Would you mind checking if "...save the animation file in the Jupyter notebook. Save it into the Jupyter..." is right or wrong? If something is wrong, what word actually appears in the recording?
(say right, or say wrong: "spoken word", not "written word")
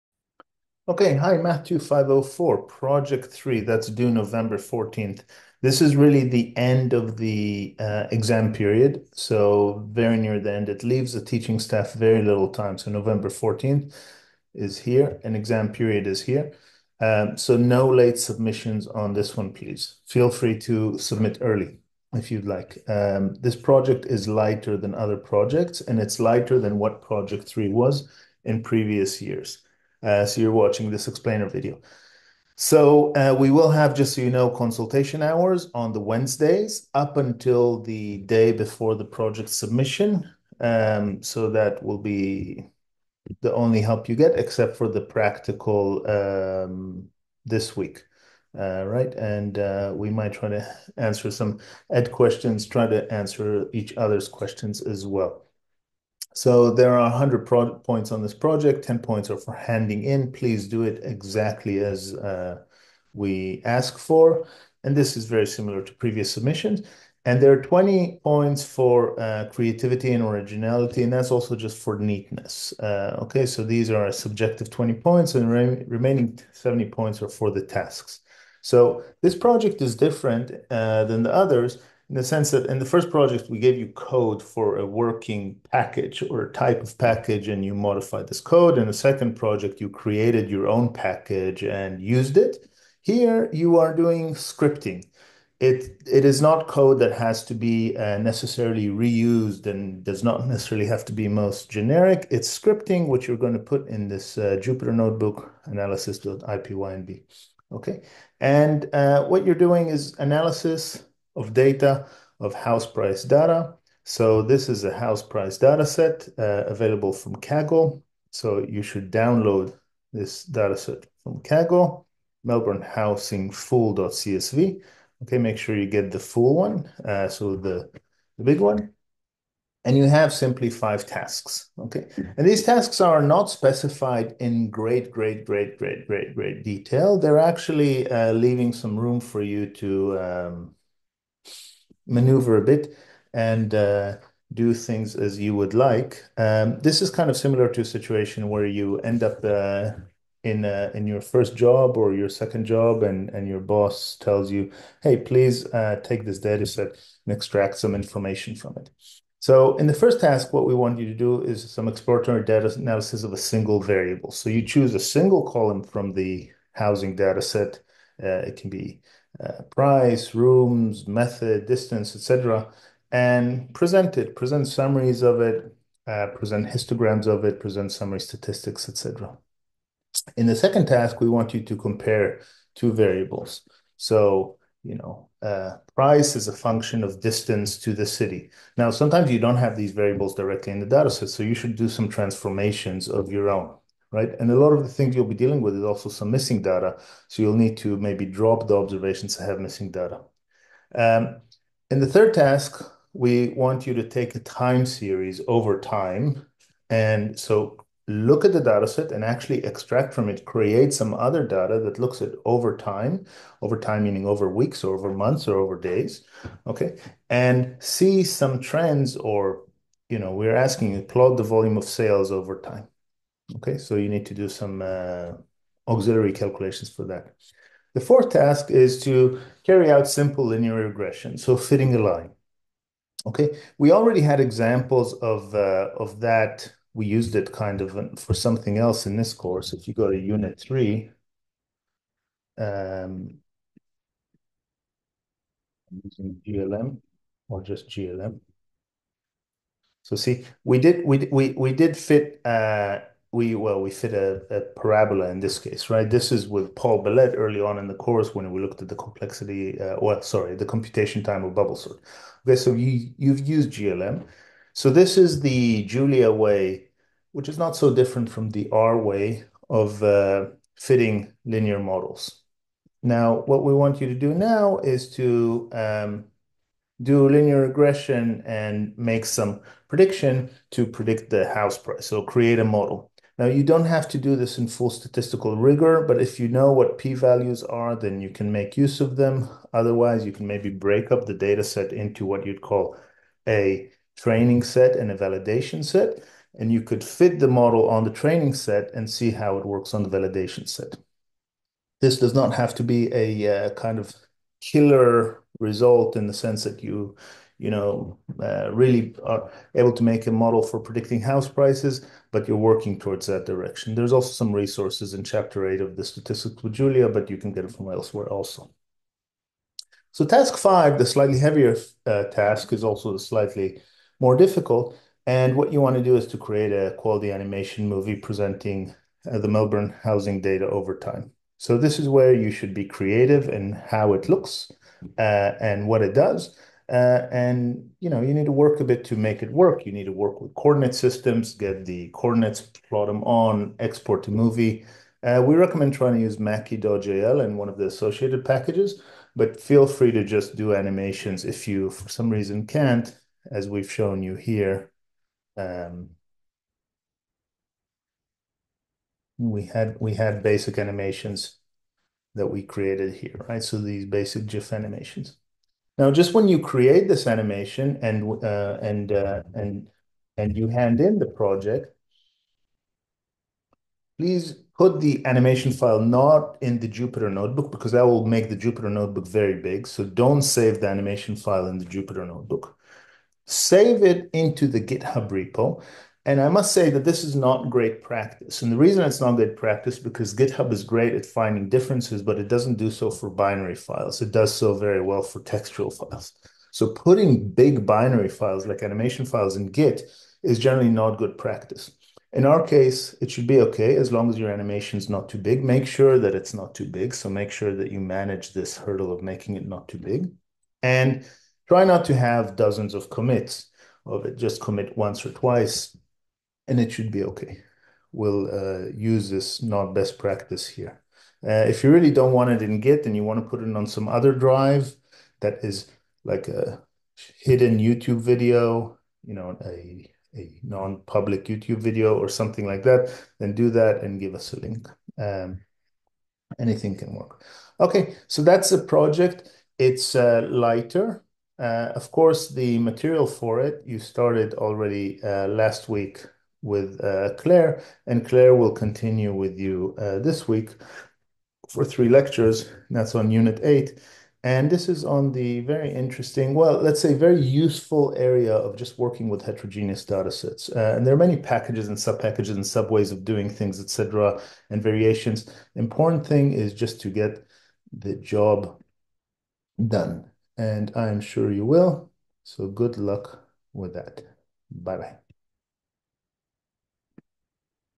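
wrong: "GitHub", not "Jupyter".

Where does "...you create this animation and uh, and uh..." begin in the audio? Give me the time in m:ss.
6:06.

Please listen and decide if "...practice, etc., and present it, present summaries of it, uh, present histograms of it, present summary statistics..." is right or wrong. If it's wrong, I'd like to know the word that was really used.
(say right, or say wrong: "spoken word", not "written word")
wrong: "distance", not "practice".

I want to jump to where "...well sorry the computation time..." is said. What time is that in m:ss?
4:20.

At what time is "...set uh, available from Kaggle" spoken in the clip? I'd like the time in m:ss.
1:55.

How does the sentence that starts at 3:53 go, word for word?
Okay, we already had examples of, uh, of that.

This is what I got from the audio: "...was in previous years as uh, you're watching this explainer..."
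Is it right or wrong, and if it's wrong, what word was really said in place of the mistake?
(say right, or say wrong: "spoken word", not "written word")
right.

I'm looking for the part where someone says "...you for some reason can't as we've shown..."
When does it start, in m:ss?
5:51.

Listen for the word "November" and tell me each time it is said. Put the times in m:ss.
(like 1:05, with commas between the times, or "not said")
0:04, 0:12.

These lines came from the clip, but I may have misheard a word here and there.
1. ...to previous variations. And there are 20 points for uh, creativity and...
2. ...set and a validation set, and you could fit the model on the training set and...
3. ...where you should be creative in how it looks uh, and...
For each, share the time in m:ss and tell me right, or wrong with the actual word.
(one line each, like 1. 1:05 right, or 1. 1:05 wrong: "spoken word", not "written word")
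1. 1:05 wrong: "submissions", not "variations"
2. 4:54 right
3. 5:32 right.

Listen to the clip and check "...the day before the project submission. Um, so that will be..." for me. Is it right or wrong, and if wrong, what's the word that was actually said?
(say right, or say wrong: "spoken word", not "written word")
right.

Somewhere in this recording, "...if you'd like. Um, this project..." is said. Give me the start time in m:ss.
0:22.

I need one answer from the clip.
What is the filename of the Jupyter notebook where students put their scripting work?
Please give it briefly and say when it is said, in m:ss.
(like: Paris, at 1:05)
analysis.ipynb, at 1:45.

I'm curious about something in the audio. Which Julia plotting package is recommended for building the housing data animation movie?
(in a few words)
Makie.jl.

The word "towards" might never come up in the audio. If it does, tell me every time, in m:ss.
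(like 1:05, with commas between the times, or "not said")
5:12.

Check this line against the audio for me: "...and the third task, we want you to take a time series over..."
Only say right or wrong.
right.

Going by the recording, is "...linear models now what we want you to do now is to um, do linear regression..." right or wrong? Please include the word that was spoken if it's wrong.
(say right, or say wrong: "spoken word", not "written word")
right.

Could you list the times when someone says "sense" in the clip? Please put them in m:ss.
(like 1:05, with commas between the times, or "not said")
1:22, 5:06.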